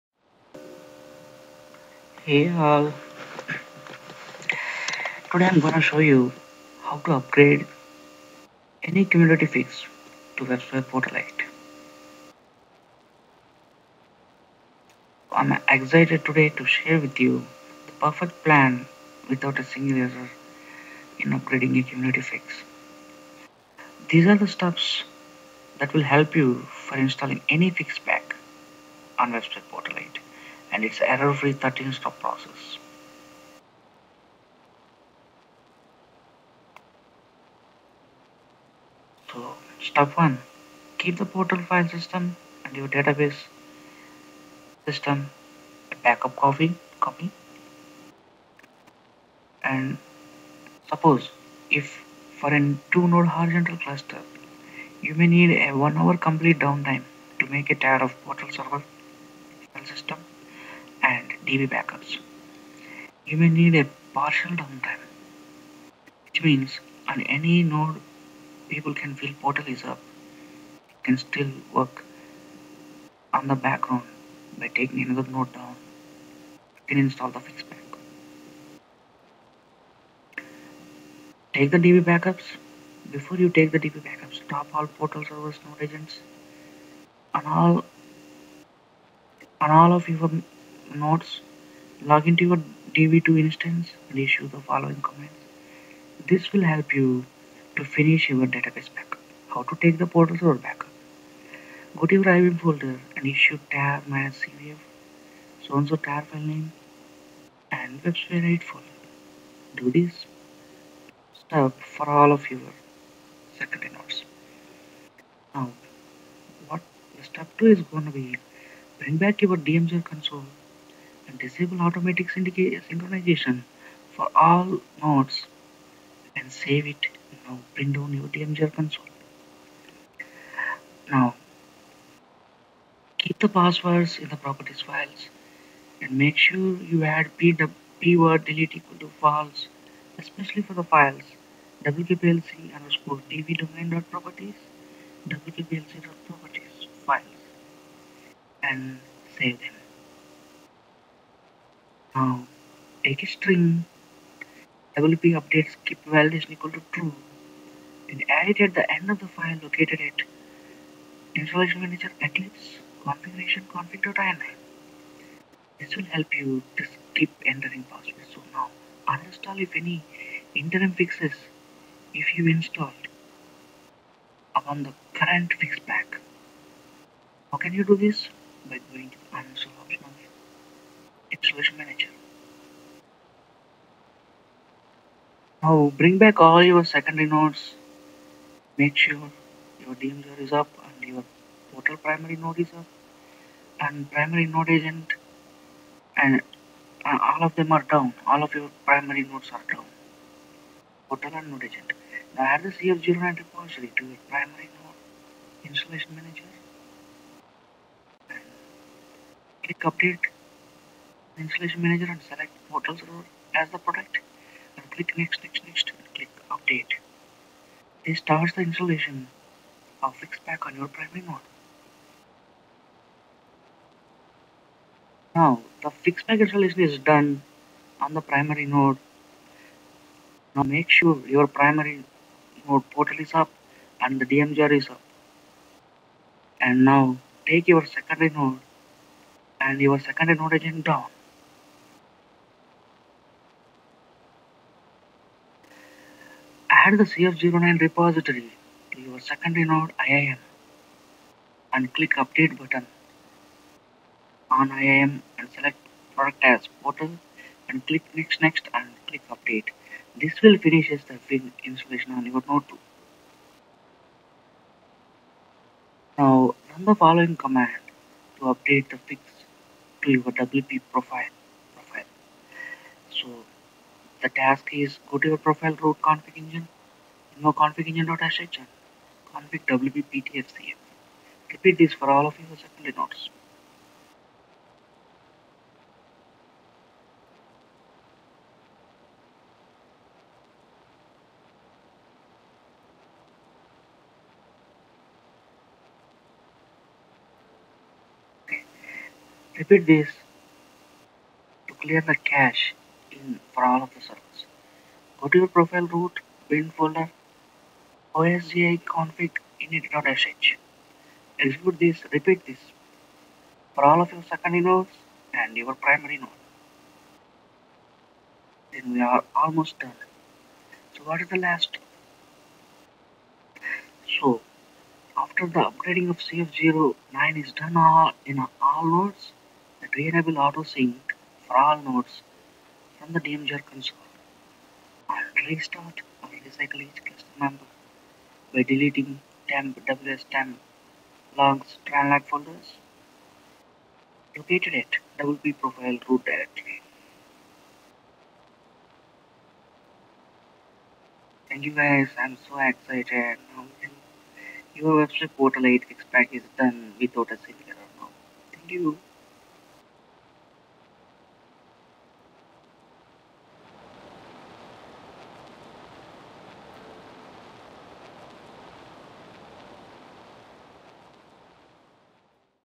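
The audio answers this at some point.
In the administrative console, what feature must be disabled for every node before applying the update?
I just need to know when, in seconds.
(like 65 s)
121 s.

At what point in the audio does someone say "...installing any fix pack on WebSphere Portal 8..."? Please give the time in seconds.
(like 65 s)
26 s.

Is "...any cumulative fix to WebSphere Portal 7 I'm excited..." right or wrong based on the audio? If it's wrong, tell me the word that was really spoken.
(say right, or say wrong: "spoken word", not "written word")
wrong: "8", not "7".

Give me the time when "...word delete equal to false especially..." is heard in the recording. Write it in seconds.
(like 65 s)
138 s.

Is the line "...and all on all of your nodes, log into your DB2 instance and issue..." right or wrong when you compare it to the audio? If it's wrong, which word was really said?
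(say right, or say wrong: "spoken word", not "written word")
right.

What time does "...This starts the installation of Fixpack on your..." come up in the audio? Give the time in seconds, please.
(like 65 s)
218 s.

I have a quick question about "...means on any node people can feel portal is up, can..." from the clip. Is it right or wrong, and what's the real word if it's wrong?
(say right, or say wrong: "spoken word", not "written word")
right.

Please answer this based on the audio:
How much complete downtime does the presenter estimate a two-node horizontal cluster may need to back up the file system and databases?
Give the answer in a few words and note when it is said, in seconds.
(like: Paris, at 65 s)
1 hour, at 55 s.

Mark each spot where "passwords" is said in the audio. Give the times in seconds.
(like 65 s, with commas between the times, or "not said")
133 s, 167 s.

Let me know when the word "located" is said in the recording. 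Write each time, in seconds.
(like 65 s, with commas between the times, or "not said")
159 s, 344 s.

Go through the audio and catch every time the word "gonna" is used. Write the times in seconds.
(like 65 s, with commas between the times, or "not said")
5 s.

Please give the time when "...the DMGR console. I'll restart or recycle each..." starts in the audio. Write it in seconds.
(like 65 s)
333 s.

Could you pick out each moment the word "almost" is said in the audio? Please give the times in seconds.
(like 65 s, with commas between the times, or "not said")
319 s.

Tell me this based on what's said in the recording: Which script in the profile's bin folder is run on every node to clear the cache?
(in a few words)
osgi config init.sh.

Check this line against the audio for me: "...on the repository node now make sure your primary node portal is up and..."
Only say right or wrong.
wrong.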